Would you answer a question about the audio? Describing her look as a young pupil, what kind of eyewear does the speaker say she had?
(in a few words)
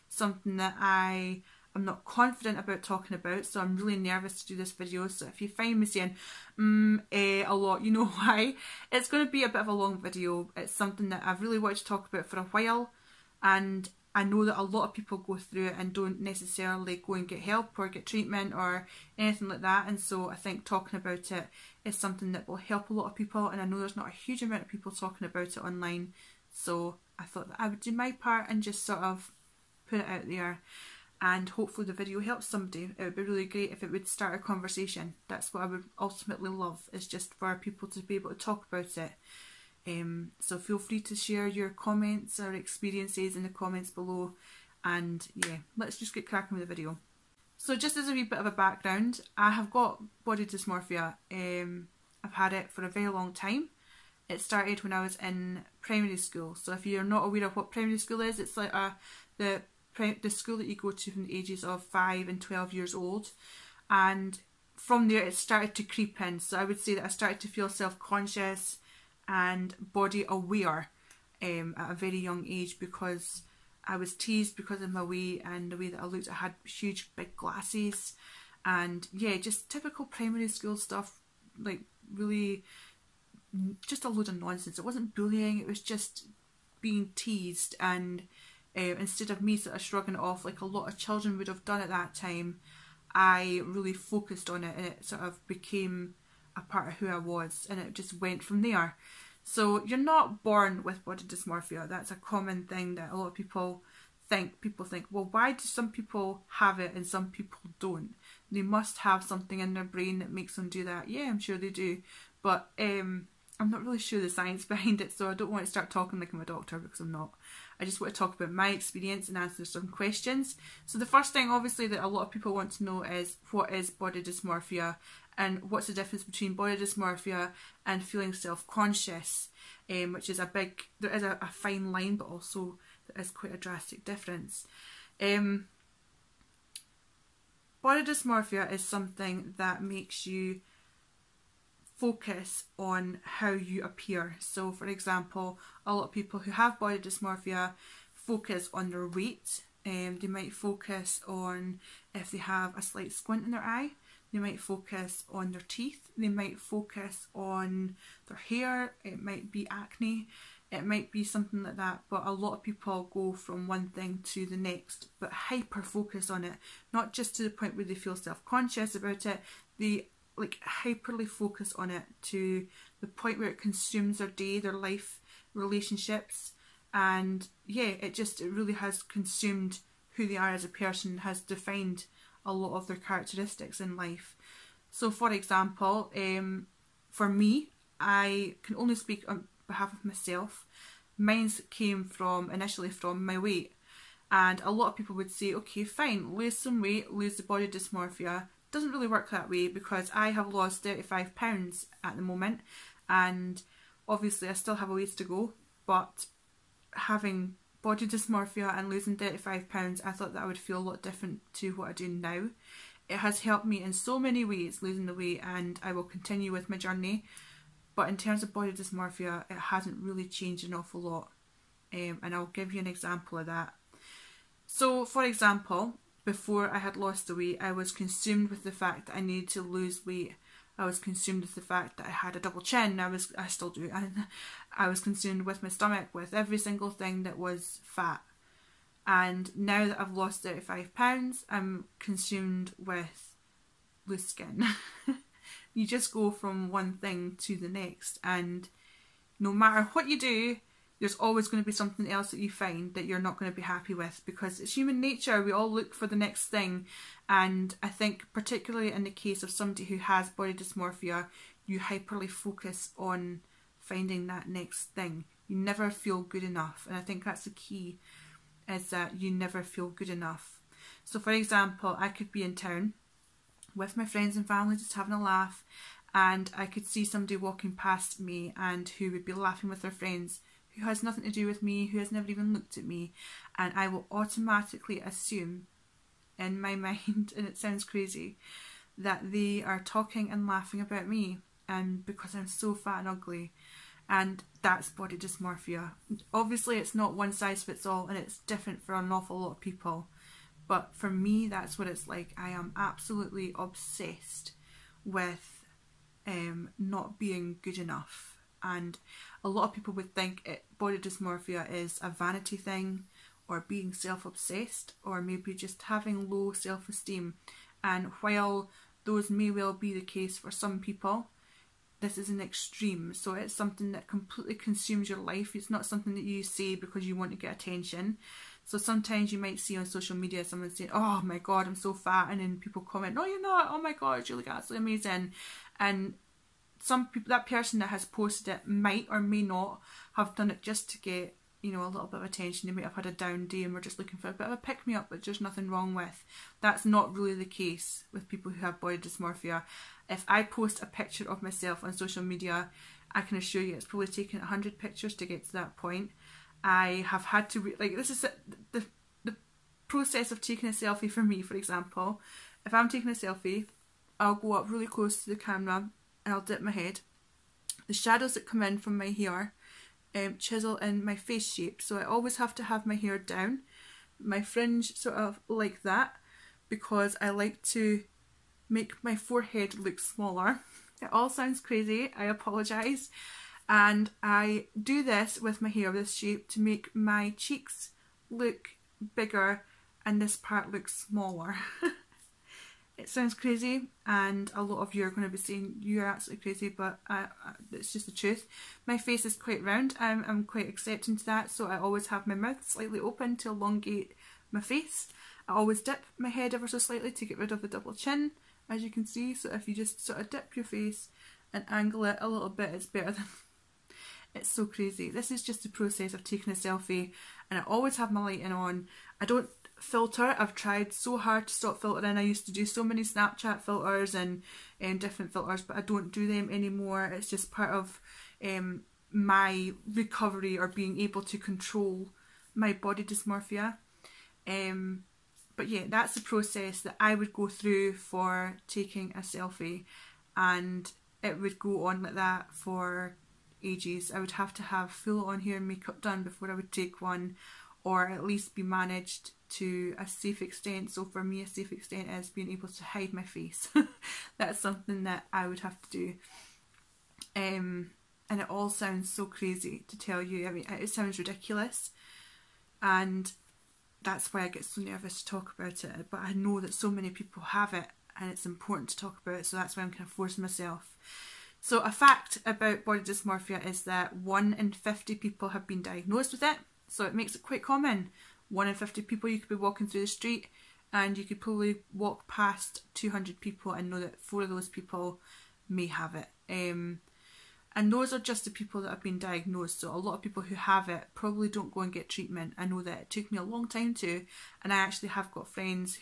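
huge big glasses.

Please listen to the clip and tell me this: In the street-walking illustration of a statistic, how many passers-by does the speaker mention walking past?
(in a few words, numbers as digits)
200.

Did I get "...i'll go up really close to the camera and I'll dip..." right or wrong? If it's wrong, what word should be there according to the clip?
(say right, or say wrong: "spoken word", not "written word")
right.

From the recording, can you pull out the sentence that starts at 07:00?
I've tried so hard to stop filtering.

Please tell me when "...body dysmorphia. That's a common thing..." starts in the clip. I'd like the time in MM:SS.
01:41.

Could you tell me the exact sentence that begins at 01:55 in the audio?
So I don't want to start talking like I'm a doctor because I'm not.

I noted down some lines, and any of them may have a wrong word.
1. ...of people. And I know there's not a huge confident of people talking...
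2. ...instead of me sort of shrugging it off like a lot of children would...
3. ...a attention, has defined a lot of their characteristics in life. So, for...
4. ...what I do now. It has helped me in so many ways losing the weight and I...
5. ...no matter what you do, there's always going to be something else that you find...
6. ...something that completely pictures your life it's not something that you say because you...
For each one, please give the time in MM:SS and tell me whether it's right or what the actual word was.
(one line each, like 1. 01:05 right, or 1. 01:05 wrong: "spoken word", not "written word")
1. 00:23 wrong: "amount", not "confident"
2. 01:28 right
3. 03:00 wrong: "person", not "attention"
4. 03:31 right
5. 04:09 right
6. 05:23 wrong: "consumes", not "pictures".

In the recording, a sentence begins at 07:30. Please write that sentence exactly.
So for me, a safe extent is being able to hide my face.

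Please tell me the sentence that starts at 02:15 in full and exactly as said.
Um, body dysmorphia is something that makes you focus on how you appear.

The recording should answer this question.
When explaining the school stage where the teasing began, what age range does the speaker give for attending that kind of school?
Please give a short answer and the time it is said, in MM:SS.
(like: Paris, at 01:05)
5 and 12, at 01:01.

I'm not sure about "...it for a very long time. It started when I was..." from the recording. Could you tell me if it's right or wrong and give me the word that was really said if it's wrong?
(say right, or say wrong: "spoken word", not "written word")
right.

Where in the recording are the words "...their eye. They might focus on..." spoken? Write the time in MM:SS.
02:33.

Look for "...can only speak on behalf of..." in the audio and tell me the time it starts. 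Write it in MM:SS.
03:08.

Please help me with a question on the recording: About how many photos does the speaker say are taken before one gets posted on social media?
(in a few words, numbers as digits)
100.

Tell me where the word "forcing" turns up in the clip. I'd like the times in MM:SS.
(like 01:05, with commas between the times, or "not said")
07:50.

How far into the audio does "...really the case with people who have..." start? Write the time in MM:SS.
05:47.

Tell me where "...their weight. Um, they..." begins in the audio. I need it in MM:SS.
02:28.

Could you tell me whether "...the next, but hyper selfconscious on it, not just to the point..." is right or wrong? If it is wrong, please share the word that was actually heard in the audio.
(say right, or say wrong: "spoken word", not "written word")
wrong: "focus", not "selfconscious".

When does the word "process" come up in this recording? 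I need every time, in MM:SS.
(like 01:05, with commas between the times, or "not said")
05:59, 06:55, 07:16.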